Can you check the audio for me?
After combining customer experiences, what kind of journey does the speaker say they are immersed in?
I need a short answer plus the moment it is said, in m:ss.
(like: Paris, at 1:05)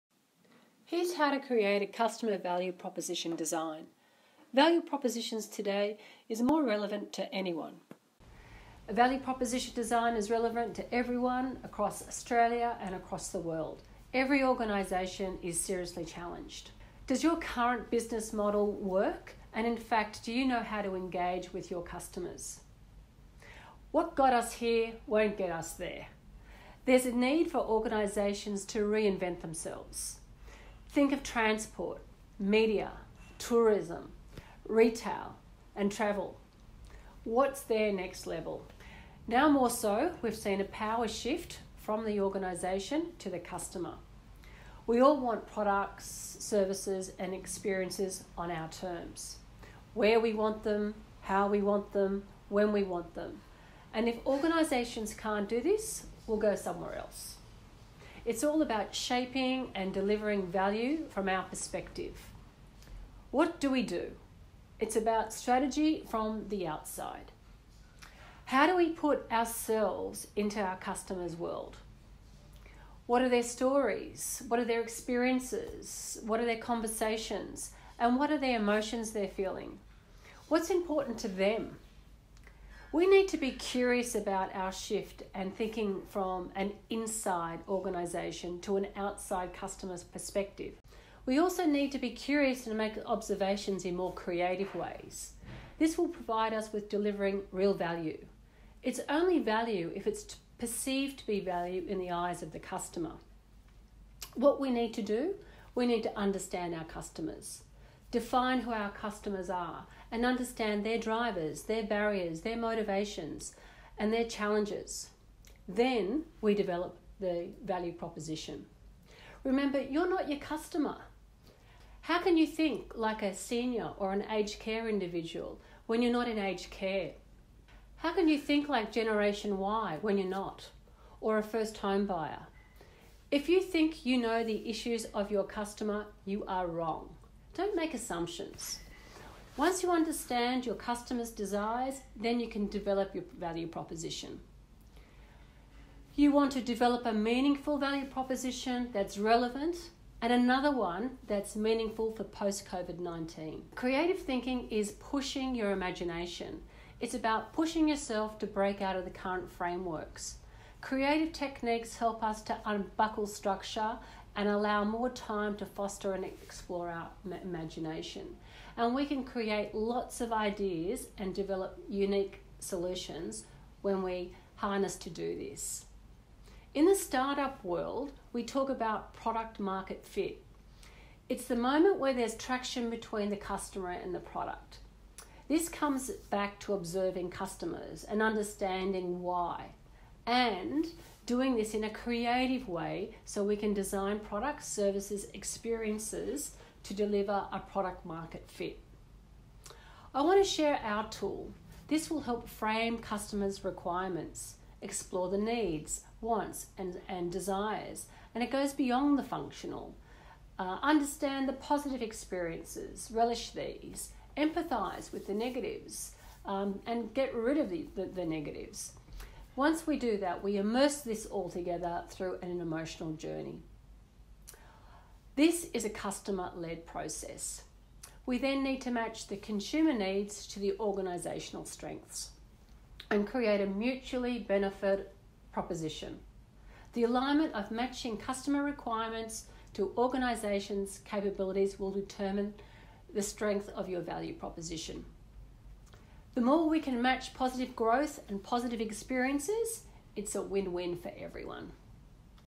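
emotional journey, at 3:42.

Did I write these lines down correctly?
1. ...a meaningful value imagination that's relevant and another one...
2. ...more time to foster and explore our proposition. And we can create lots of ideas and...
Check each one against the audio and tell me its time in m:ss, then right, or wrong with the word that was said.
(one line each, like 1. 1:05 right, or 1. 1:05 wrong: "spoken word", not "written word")
1. 2:27 wrong: "proposition", not "imagination"
2. 2:44 wrong: "imagination", not "proposition".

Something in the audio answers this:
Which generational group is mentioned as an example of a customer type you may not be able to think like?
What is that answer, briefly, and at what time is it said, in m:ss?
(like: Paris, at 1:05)
Generation Y, at 2:08.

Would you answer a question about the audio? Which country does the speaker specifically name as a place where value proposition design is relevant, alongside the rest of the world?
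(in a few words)
Australia.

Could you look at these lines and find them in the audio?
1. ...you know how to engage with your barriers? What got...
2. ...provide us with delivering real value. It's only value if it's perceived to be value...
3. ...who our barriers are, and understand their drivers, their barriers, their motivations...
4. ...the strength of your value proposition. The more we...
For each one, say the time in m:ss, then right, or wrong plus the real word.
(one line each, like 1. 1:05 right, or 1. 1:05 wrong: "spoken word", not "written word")
1. 0:20 wrong: "customers", not "barriers"
2. 1:36 right
3. 1:48 wrong: "customers", not "barriers"
4. 4:03 right.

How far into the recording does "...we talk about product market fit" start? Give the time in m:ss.
2:58.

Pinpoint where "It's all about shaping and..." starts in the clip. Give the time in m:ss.
0:58.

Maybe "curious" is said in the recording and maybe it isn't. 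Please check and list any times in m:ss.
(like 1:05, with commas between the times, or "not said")
1:23, 1:32.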